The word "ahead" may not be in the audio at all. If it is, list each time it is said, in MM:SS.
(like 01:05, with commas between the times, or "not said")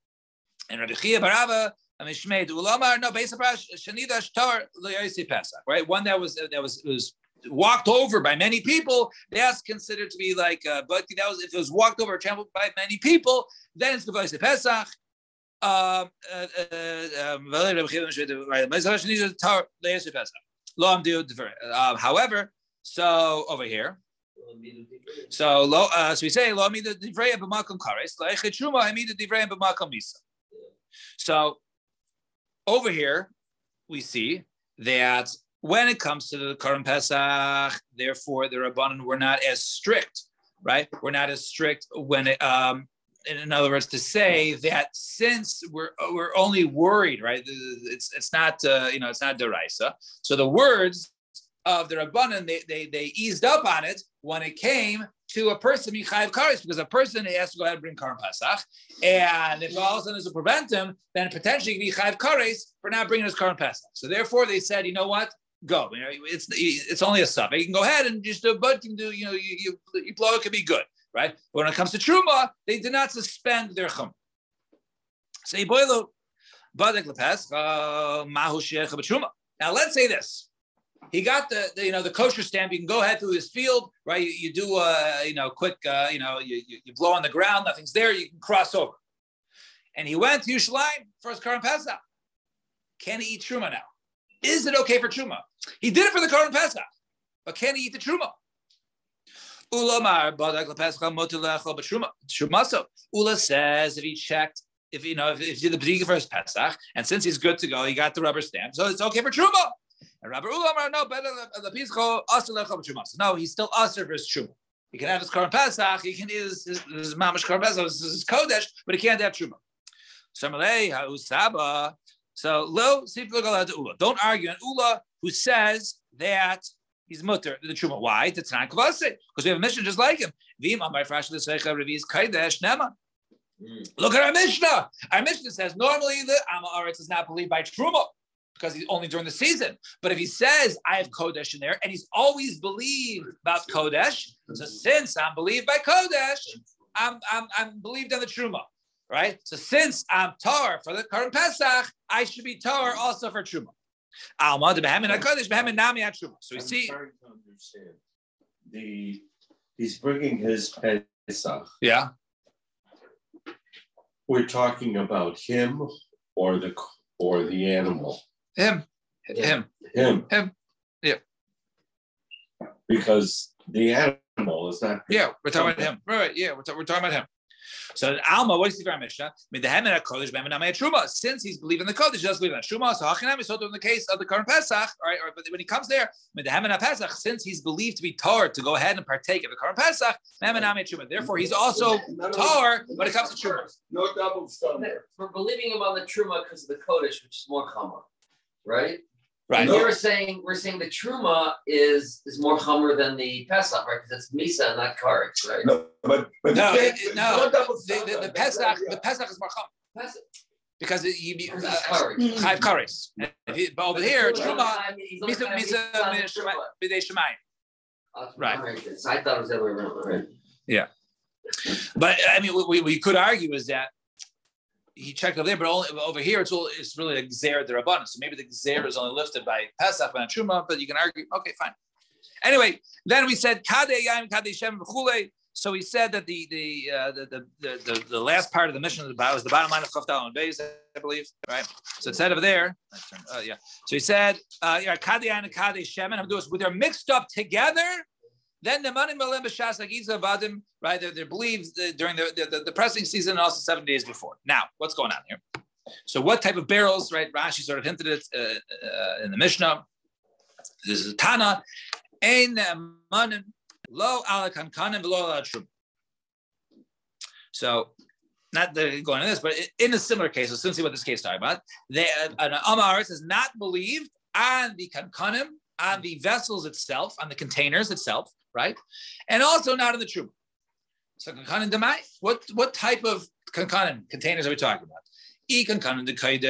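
00:57, 01:07, 01:23, 03:08.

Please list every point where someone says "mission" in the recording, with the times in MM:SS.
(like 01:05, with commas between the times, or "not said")
02:09, 03:58.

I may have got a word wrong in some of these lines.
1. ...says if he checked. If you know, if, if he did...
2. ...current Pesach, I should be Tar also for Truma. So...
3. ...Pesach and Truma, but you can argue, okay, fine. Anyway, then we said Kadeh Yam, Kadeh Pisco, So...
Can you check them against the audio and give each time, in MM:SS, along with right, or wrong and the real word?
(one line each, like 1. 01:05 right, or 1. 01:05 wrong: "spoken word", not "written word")
1. 01:43 right
2. 02:31 right
3. 03:49 wrong: "Shem", not "Pisco".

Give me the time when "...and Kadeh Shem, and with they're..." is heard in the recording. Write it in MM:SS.
04:05.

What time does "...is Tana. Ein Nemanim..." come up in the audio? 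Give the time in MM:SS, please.
04:21.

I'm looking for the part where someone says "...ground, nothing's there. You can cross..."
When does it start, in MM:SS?
01:27.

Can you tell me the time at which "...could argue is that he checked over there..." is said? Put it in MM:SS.
03:42.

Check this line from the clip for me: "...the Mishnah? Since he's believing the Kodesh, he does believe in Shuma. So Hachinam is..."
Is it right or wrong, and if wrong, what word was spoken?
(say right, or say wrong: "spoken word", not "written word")
right.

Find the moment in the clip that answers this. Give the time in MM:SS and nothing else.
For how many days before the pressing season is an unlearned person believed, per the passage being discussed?
04:13.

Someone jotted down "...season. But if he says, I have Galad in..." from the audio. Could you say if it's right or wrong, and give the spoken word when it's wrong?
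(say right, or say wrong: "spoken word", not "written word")
wrong: "Kodesh", not "Galad".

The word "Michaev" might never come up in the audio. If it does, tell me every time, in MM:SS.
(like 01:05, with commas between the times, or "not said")
00:55, 01:01.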